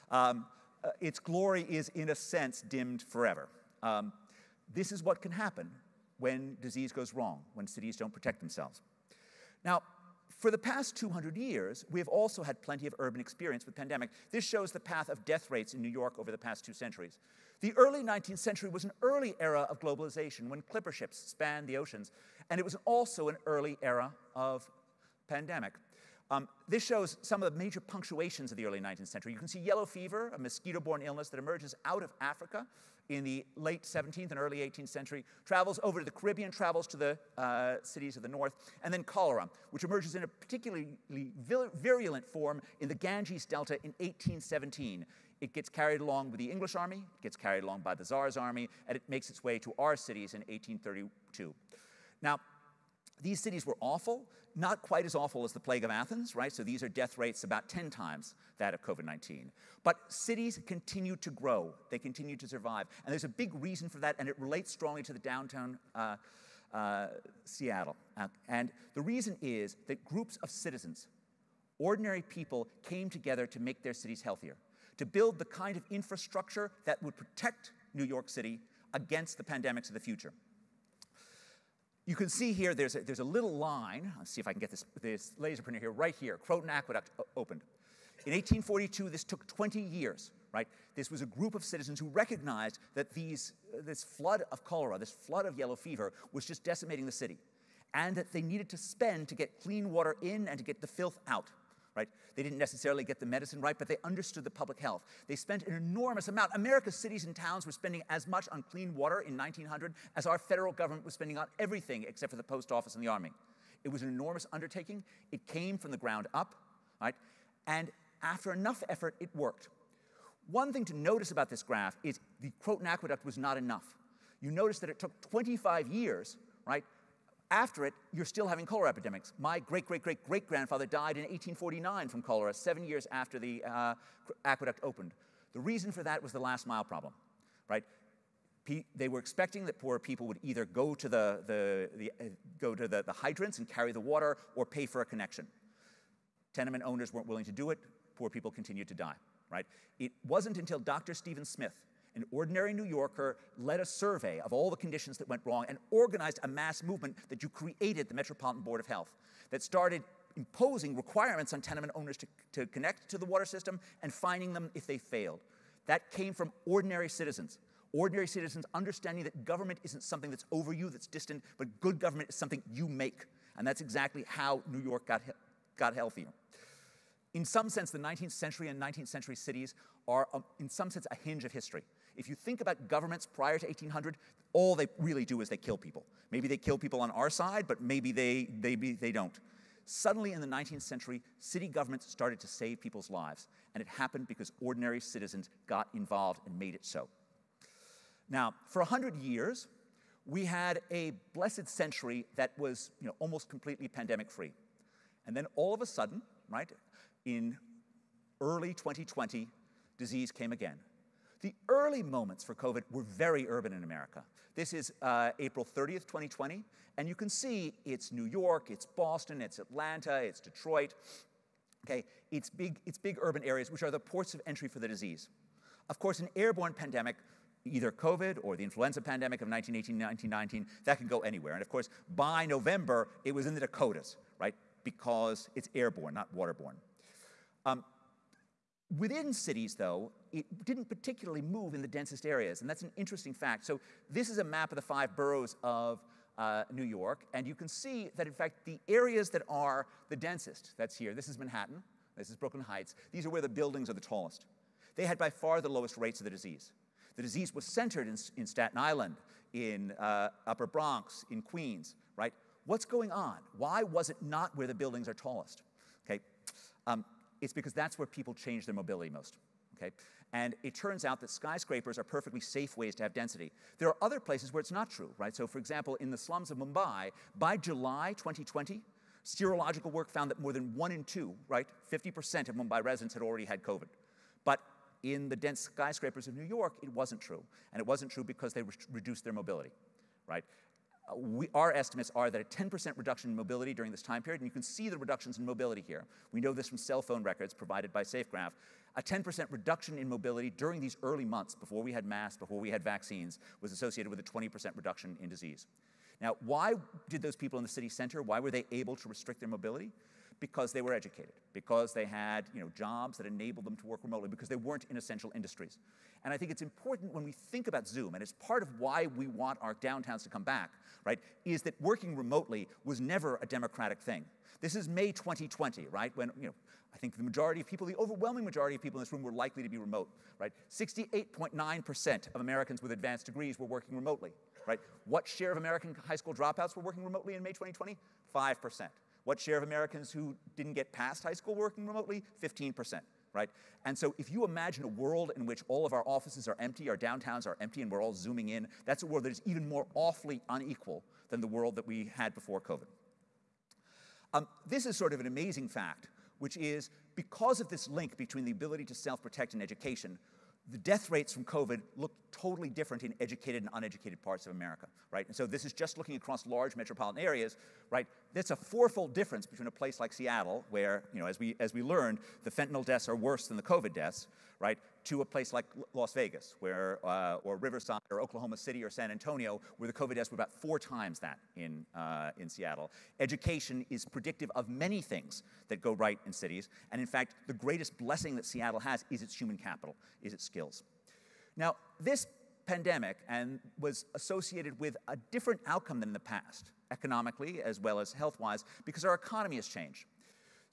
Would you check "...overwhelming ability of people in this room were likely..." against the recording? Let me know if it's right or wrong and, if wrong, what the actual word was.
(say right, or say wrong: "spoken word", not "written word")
wrong: "majority", not "ability".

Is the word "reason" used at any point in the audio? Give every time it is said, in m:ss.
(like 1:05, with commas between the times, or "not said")
1:03, 1:09, 2:15.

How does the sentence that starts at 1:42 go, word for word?
They didn't necessarily get the medicine right, but they understood the public health.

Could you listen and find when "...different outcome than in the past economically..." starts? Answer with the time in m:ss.
6:35.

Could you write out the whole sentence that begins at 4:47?
And it wasn't true because they re reduced their mobility, right?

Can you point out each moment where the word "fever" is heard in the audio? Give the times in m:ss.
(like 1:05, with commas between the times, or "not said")
0:29, 1:35.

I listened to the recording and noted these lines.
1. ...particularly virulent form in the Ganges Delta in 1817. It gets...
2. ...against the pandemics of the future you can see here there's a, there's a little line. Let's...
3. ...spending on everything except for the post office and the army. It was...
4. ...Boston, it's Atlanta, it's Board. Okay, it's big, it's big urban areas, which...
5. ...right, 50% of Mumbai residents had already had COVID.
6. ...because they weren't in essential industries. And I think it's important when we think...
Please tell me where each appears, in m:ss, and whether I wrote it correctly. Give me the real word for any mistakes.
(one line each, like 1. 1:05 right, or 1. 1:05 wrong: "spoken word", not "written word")
1. 0:40 right
2. 1:18 right
3. 1:51 right
4. 3:38 wrong: "Detroit", not "Board"
5. 4:41 right
6. 5:14 right.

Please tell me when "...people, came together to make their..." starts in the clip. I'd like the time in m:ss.
1:12.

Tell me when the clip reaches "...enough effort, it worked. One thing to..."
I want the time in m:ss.
1:58.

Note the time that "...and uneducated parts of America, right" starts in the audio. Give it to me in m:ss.
6:03.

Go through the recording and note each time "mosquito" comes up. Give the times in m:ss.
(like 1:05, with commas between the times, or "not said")
0:30.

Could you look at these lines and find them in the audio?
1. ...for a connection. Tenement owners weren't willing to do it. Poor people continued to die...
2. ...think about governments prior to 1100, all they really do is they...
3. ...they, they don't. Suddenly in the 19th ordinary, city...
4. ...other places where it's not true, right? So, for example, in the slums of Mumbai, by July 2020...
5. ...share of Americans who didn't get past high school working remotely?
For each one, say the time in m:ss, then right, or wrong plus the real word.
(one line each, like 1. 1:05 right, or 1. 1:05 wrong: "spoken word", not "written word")
1. 2:24 right
2. 3:02 wrong: "1800", not "1100"
3. 3:08 wrong: "century", not "ordinary"
4. 4:34 right
5. 5:39 right.